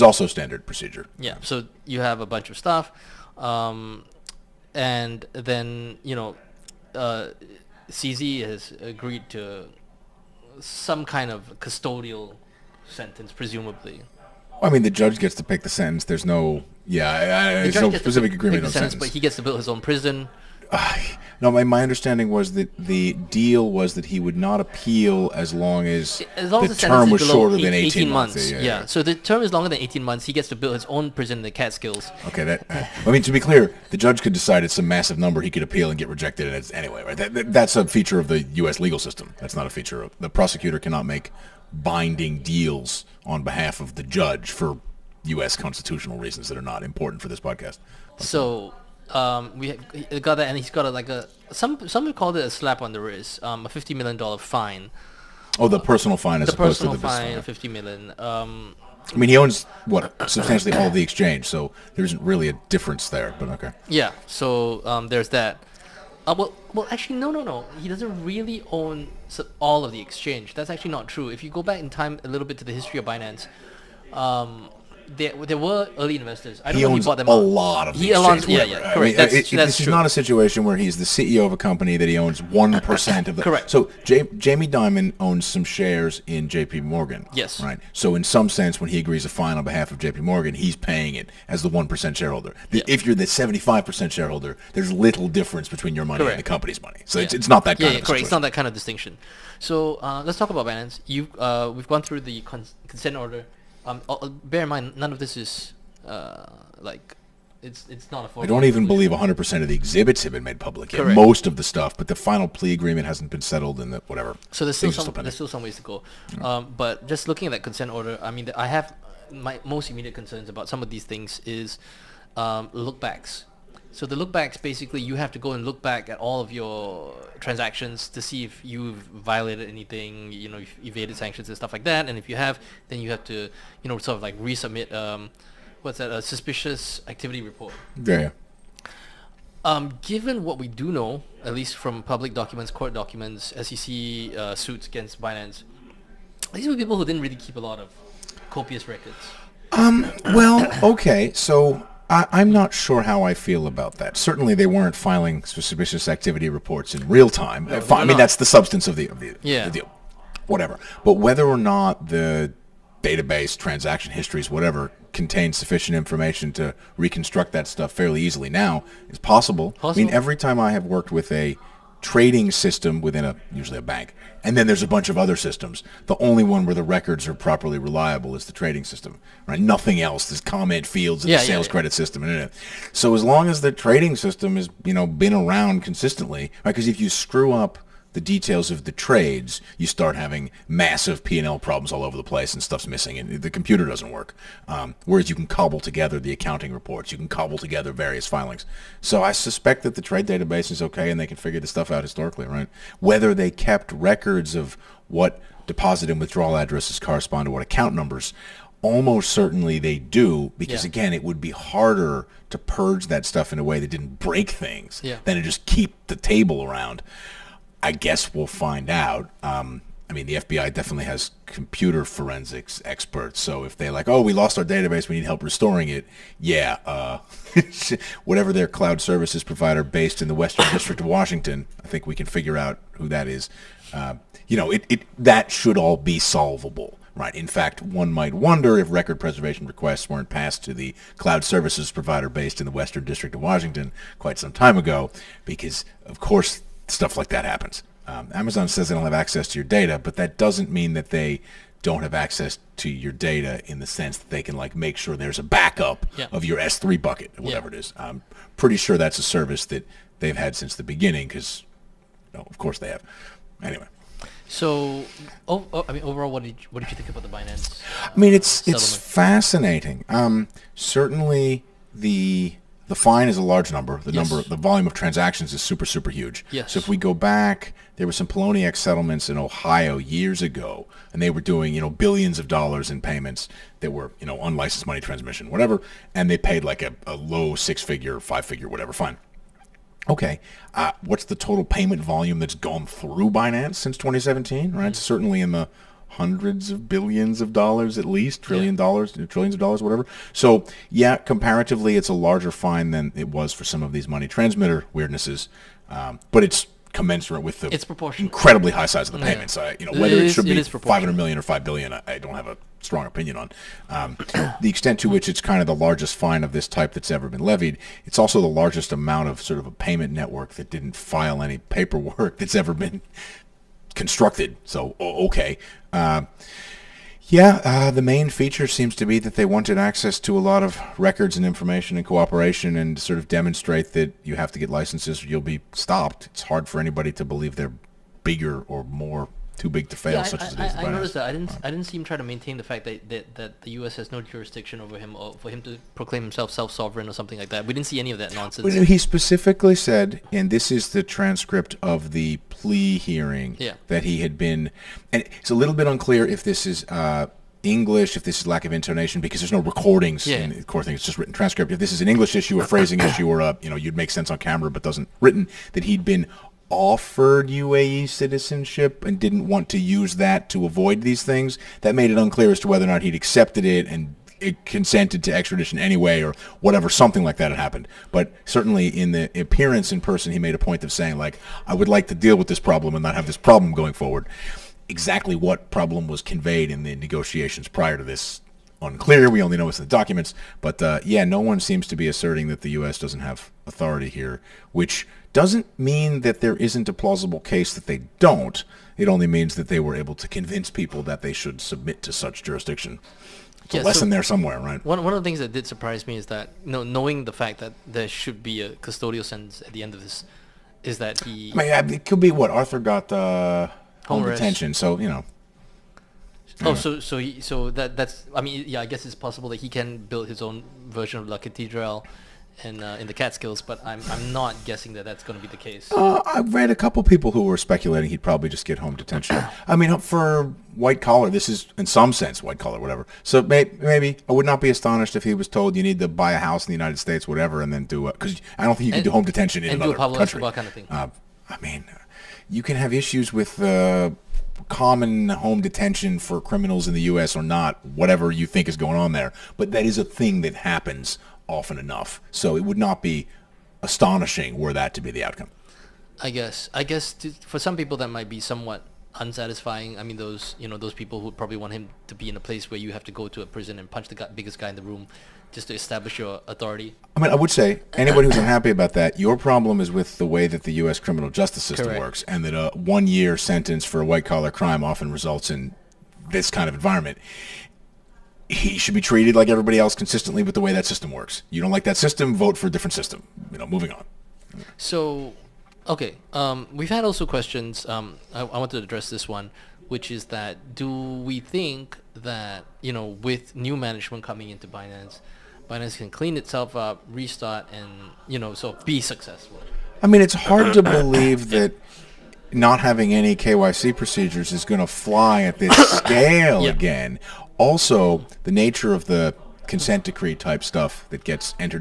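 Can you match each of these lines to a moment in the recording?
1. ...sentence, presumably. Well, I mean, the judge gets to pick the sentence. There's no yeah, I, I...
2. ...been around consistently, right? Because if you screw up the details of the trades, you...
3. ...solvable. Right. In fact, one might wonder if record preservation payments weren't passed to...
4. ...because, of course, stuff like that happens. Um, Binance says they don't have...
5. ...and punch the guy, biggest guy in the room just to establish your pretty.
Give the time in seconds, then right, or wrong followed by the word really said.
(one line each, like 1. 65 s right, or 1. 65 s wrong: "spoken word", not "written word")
1. 12 s right
2. 185 s right
3. 236 s wrong: "requests", not "payments"
4. 245 s wrong: "Amazon", not "Binance"
5. 463 s wrong: "authority", not "pretty".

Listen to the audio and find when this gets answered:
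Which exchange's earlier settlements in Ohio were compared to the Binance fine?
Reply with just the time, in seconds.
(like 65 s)
278 s.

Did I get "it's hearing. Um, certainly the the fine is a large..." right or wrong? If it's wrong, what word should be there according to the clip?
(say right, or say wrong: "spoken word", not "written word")
wrong: "fascinating", not "hearing".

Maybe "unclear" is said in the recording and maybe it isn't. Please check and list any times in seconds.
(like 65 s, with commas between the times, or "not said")
355 s, 372 s, 388 s.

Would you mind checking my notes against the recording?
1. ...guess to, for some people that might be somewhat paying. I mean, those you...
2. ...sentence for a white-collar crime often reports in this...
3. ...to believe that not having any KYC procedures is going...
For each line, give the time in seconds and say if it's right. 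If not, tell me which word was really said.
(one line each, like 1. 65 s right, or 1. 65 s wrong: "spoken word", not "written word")
1. 456 s wrong: "unsatisfying", not "paying"
2. 473 s wrong: "results", not "reports"
3. 500 s right.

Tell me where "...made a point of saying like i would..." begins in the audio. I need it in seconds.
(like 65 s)
380 s.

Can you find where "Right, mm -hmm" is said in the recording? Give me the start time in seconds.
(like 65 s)
294 s.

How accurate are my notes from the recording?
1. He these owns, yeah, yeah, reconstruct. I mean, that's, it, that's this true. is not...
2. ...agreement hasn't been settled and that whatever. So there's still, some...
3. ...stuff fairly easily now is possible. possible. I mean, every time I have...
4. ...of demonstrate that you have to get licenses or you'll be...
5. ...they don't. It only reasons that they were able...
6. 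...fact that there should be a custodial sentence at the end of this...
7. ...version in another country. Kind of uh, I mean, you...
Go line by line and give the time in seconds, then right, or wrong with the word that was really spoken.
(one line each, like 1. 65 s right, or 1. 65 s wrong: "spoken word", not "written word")
1. 77 s wrong: "correct", not "reconstruct"
2. 112 s right
3. 167 s right
4. 333 s right
5. 397 s wrong: "means", not "reasons"
6. 407 s right
7. 439 s wrong: "detention", not "version".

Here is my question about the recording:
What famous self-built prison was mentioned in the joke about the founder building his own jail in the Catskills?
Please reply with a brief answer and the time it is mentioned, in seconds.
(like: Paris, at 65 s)
La Catedral, at 421 s.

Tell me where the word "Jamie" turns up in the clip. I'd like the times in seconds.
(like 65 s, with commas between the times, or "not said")
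84 s.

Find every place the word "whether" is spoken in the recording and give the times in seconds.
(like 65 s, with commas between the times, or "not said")
161 s, 202 s, 309 s, 372 s.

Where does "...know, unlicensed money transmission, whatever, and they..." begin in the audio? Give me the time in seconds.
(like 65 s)
284 s.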